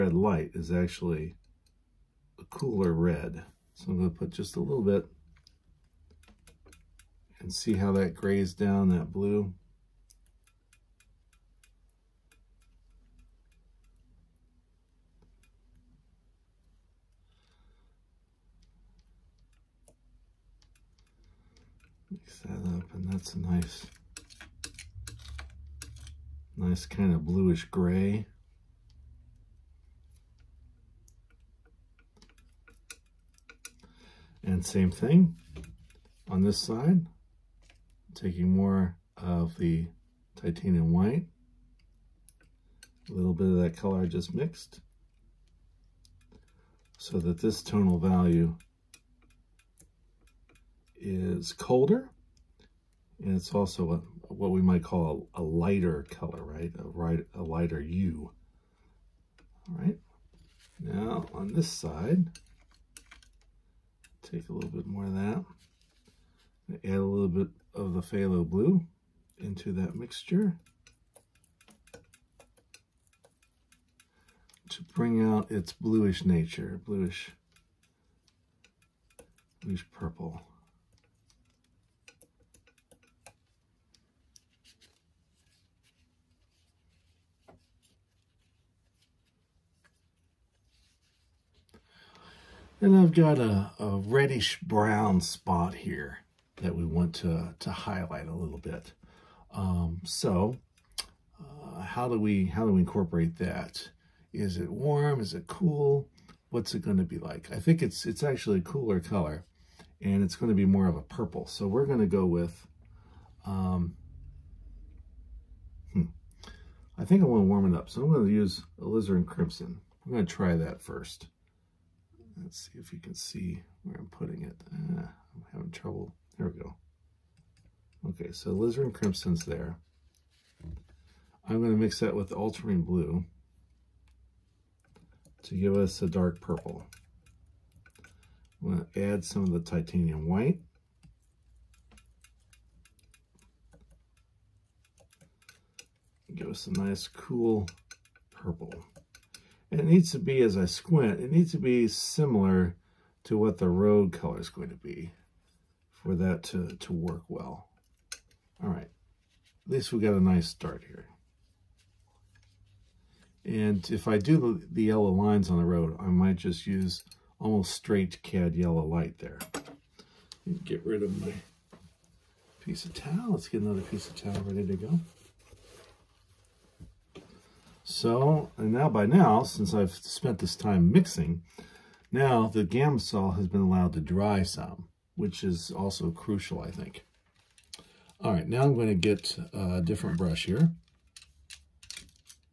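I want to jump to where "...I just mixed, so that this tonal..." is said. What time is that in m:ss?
0:44.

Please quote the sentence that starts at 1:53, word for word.
Um, hmm, I think I want to warm it up, so I'm going to use alizarin crimson.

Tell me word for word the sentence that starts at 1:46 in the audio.
What's it going to be like?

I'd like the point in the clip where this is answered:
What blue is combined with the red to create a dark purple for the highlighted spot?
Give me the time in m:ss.
2:12.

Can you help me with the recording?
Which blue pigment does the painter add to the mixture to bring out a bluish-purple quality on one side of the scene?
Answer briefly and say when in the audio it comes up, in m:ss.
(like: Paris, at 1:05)
Phthalo blue, at 1:08.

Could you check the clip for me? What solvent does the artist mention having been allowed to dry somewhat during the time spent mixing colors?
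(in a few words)
Gamsol.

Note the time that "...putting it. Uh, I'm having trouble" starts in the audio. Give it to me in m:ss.
2:04.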